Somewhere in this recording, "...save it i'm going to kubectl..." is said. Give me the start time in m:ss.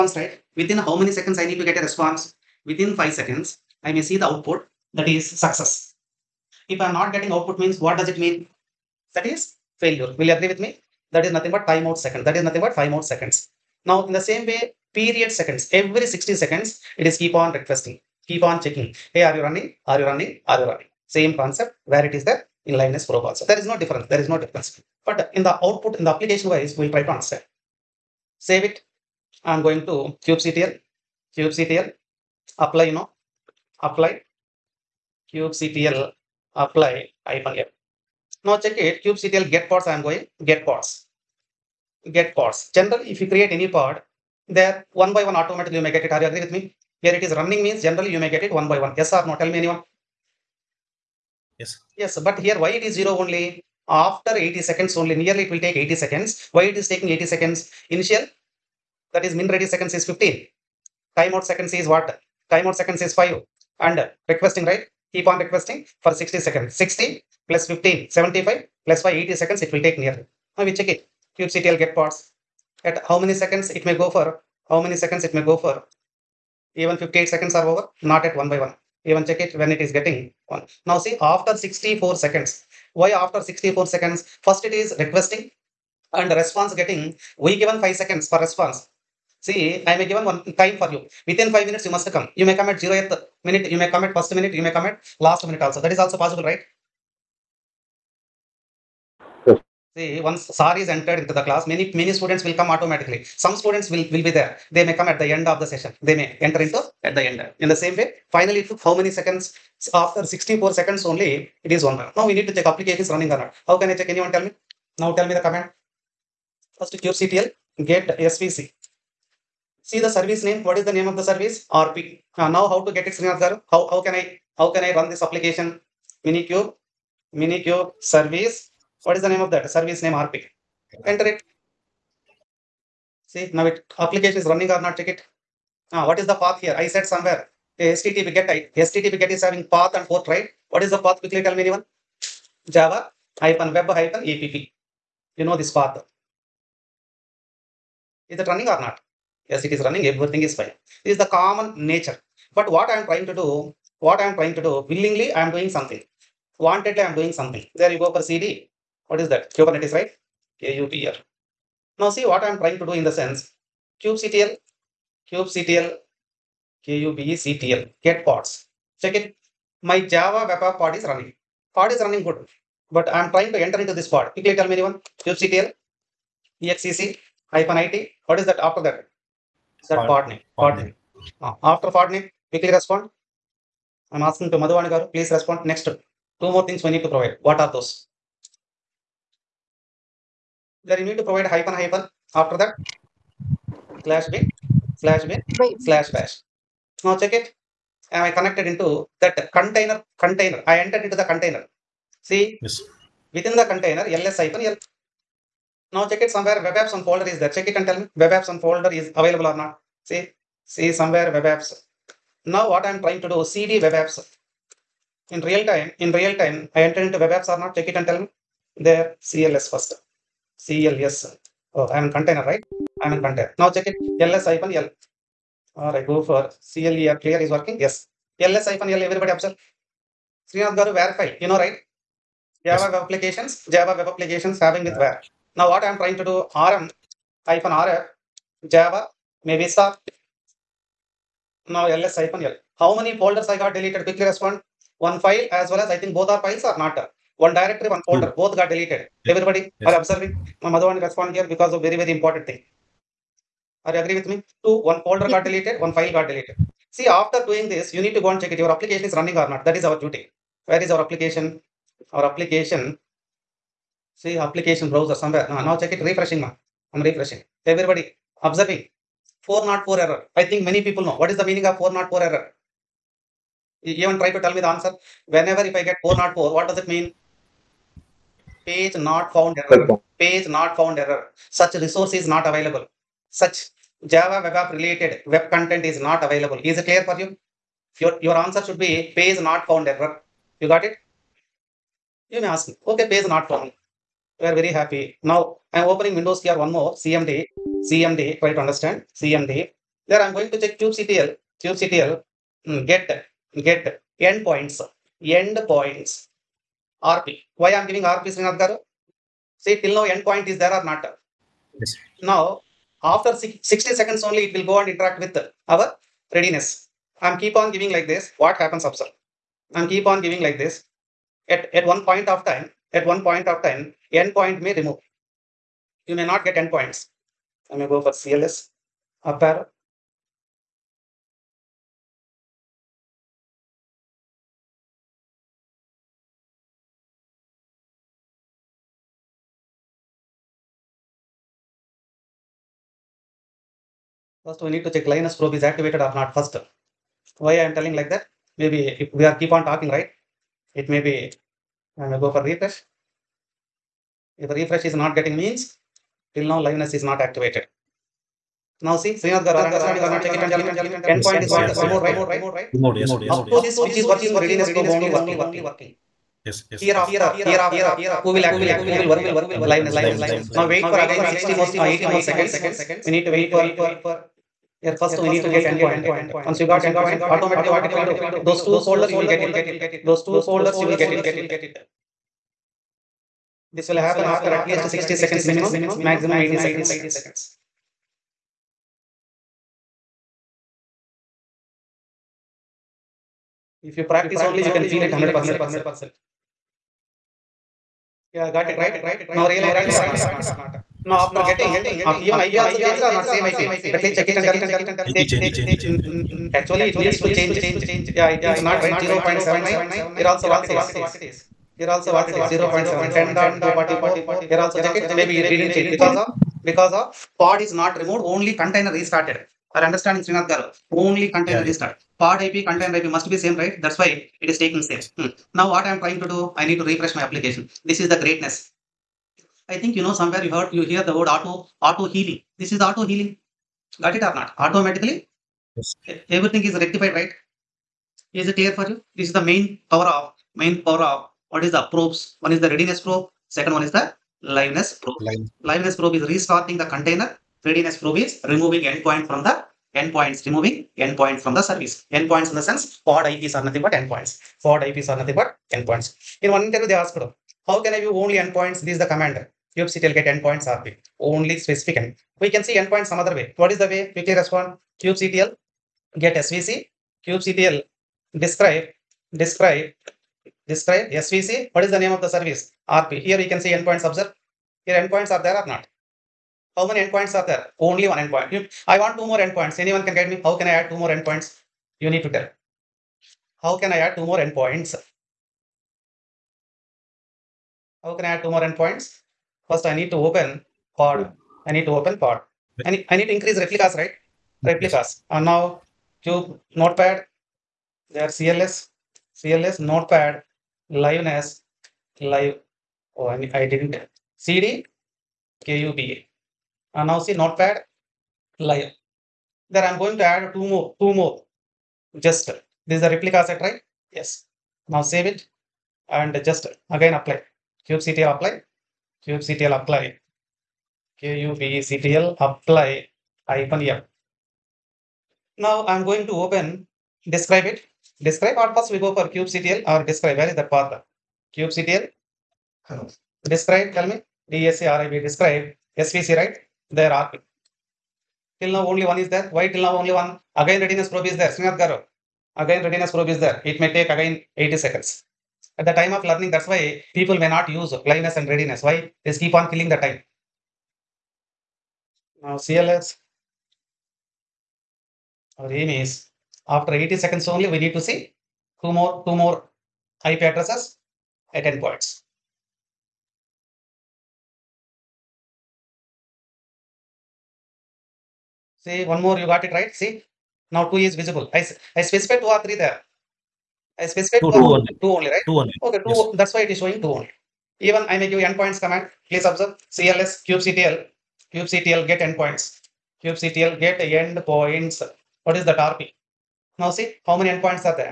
0:28.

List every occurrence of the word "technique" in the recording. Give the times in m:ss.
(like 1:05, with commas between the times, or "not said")
not said.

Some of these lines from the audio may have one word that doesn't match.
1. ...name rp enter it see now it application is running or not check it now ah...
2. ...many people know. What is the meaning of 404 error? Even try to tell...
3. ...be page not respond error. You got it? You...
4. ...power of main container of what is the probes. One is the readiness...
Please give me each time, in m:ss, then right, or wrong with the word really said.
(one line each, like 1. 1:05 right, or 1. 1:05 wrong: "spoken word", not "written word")
1. 2:10 right
2. 4:30 right
3. 4:48 wrong: "found", not "respond"
4. 7:19 wrong: "power", not "container".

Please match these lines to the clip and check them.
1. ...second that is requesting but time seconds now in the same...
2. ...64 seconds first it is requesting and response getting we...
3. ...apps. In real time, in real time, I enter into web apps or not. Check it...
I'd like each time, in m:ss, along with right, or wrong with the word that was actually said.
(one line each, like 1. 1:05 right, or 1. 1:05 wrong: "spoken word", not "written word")
1. 0:12 wrong: "nothing", not "requesting"
2. 1:23 right
3. 3:33 right.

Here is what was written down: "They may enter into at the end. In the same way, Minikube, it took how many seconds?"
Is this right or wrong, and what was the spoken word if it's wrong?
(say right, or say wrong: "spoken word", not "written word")
wrong: "Finally", not "Minikube".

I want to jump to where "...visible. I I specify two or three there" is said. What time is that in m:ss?
9:31.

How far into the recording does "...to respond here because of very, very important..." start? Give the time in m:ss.
4:10.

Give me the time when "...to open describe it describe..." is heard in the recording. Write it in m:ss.
8:46.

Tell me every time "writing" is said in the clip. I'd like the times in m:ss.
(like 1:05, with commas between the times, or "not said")
not said.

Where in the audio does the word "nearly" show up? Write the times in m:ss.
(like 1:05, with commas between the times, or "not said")
0:55, 1:09.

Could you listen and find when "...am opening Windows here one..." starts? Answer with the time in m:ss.
4:55.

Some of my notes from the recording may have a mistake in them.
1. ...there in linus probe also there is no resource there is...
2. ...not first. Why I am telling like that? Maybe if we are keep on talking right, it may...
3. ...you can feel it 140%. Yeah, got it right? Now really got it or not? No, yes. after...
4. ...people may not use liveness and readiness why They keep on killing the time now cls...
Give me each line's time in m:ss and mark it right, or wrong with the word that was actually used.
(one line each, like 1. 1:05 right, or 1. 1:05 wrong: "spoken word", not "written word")
1. 0:22 wrong: "difference", not "resource"
2. 5:46 right
3. 6:34 wrong: "100", not "140"
4. 9:07 right.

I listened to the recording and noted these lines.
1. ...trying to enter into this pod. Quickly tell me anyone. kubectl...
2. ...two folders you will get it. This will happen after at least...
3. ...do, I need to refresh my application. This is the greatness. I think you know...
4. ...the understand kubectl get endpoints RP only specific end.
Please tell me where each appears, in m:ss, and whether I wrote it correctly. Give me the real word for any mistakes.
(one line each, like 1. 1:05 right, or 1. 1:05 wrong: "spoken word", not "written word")
1. 2:53 right
2. 6:20 right
3. 7:06 right
4. 7:38 wrong: "command", not "understand".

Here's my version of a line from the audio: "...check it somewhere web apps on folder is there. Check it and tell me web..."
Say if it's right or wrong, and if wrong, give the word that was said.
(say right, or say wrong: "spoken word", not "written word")
right.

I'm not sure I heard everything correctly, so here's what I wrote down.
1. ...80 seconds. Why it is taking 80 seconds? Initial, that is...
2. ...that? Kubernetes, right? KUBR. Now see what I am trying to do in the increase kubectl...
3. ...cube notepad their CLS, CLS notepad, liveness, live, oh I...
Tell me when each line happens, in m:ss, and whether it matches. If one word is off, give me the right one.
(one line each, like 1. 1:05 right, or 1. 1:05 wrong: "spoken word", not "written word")
1. 0:55 right
2. 2:39 wrong: "sense", not "increase"
3. 8:16 right.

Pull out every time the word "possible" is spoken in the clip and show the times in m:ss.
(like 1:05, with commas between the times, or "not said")
1:36.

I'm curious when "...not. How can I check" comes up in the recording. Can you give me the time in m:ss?
1:53.